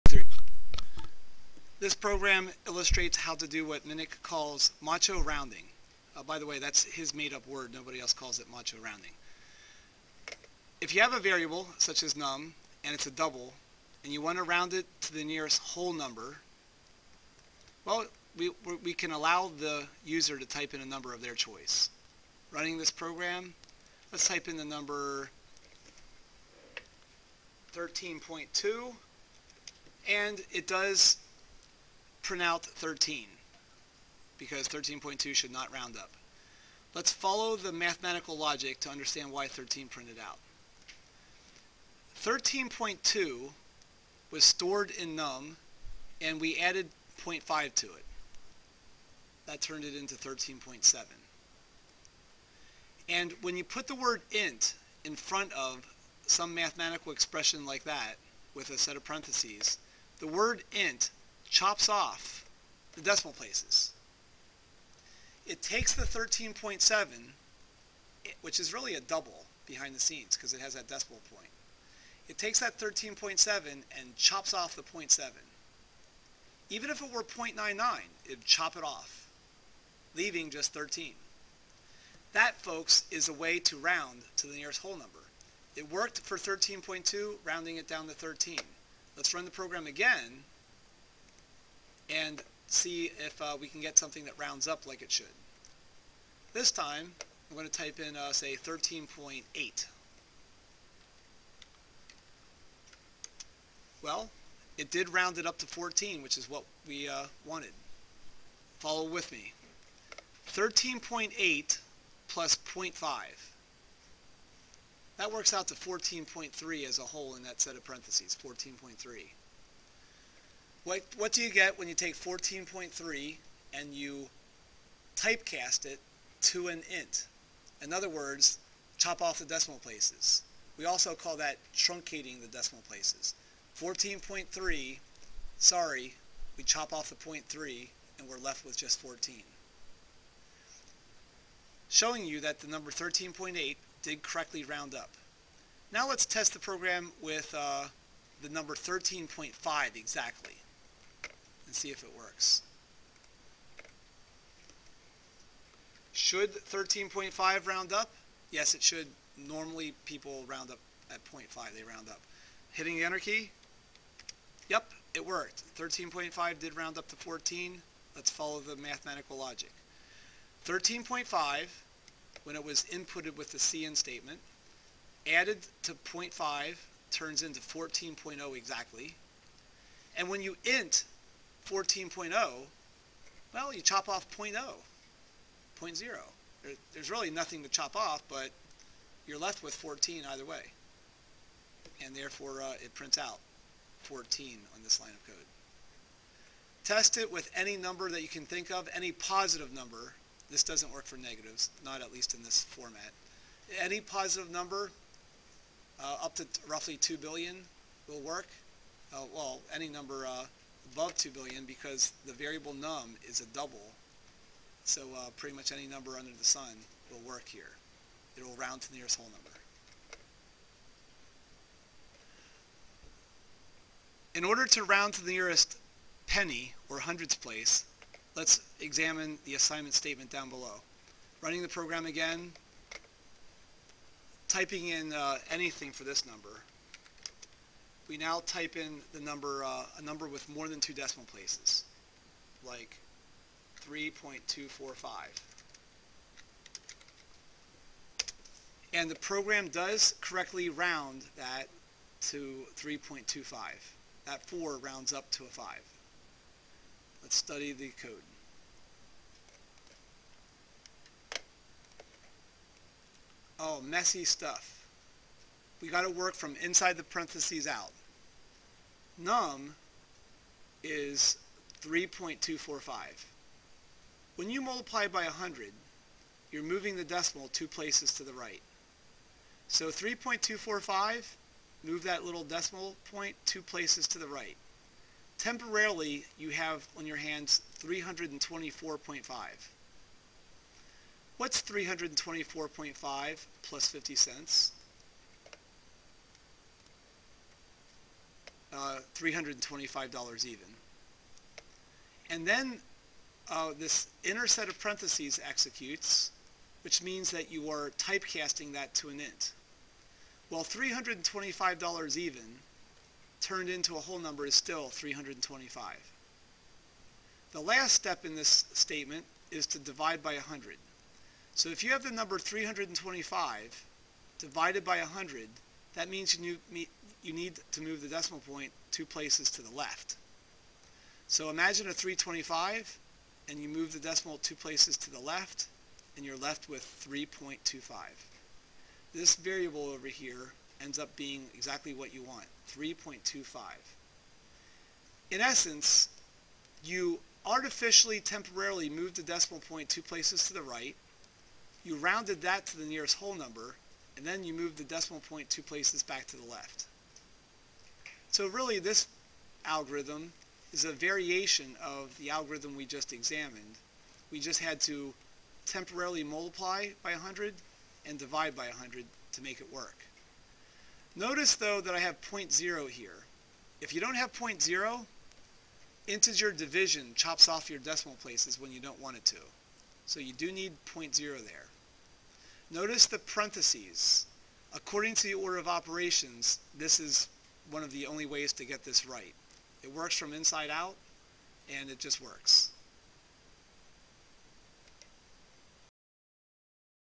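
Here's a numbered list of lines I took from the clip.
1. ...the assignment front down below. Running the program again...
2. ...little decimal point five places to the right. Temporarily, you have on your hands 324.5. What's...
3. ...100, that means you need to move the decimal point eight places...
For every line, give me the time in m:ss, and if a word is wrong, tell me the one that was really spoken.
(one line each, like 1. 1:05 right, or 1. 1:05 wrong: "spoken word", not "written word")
1. 3:49 wrong: "statement", not "front"
2. 4:42 wrong: "two", not "five"
3. 5:24 wrong: "two", not "eight".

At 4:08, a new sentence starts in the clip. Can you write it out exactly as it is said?
And the program does correctly round that to 3.25.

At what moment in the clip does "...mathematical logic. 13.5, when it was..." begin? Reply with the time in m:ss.
2:48.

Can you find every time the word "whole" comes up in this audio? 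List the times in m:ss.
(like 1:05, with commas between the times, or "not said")
0:15, 1:24, 1:57, 3:39, 5:13, 5:53.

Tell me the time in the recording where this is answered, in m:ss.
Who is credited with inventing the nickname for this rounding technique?
0:03.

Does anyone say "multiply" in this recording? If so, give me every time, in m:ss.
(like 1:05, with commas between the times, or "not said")
4:34, 6:06.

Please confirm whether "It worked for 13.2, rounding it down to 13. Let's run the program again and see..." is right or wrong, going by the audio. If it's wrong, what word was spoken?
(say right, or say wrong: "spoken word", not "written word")
right.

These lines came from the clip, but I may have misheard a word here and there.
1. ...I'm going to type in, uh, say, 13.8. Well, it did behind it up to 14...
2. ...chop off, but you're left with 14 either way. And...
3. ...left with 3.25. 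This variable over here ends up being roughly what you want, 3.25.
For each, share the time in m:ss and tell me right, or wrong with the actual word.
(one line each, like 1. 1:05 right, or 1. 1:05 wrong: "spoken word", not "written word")
1. 1:37 wrong: "round", not "behind"
2. 3:07 right
3. 5:36 wrong: "exactly", not "roughly".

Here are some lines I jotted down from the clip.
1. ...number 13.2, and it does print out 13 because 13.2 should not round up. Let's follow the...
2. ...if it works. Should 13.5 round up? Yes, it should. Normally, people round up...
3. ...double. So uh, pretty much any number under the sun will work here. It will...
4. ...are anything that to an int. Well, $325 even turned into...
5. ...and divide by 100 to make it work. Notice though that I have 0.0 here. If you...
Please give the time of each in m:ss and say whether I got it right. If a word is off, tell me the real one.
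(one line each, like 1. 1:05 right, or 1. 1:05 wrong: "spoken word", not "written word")
1. 0:24 right
2. 2:31 right
3. 3:33 right
4. 5:07 wrong: "typecasting", not "anything"
5. 6:08 right.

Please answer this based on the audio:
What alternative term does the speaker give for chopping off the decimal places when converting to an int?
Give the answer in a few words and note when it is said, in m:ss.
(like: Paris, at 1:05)
truncating, at 2:11.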